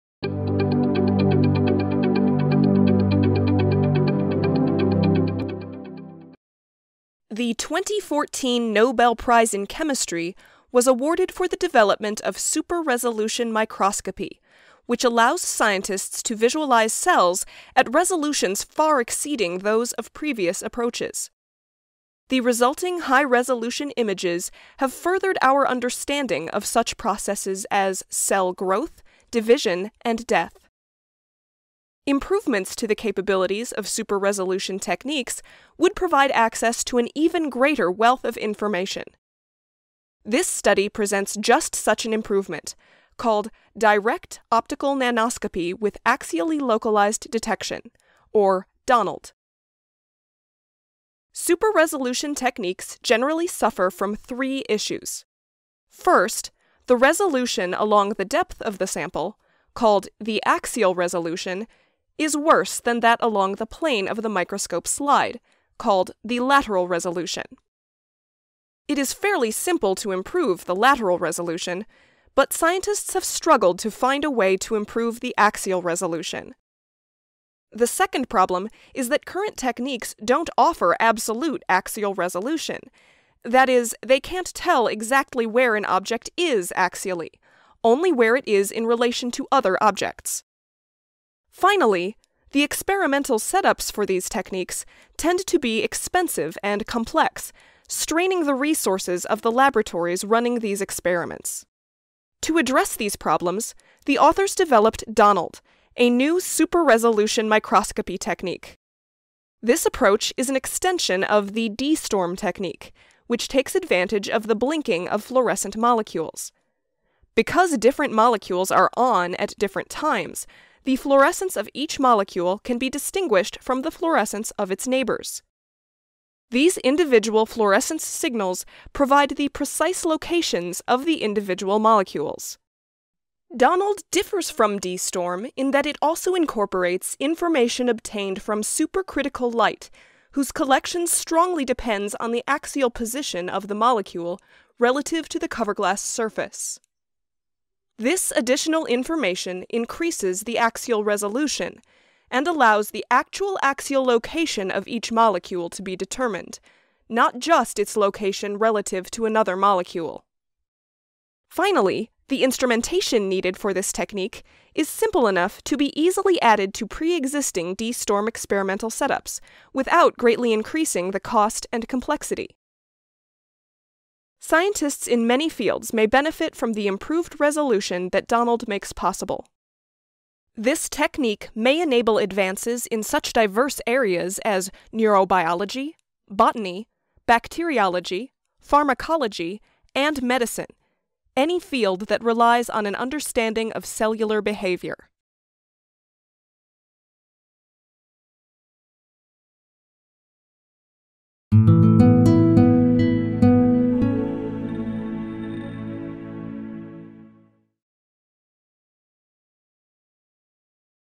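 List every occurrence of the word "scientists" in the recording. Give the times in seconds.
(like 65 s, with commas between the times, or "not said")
15 s, 72 s, 174 s.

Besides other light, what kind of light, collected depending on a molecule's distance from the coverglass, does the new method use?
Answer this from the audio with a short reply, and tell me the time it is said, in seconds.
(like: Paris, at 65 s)
supercritical light, at 138 s.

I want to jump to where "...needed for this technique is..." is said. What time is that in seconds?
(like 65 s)
163 s.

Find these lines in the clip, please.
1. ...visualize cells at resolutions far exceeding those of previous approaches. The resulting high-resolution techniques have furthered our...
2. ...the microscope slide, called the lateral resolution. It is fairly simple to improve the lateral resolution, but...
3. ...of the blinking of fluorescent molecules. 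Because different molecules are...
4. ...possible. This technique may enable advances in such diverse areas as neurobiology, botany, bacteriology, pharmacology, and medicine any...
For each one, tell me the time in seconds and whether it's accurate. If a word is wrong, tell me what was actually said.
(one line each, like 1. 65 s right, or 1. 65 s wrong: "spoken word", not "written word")
1. 16 s wrong: "images", not "techniques"
2. 64 s right
3. 114 s right
4. 178 s right.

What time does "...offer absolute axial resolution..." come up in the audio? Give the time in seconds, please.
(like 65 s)
80 s.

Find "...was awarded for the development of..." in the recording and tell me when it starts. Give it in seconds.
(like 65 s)
10 s.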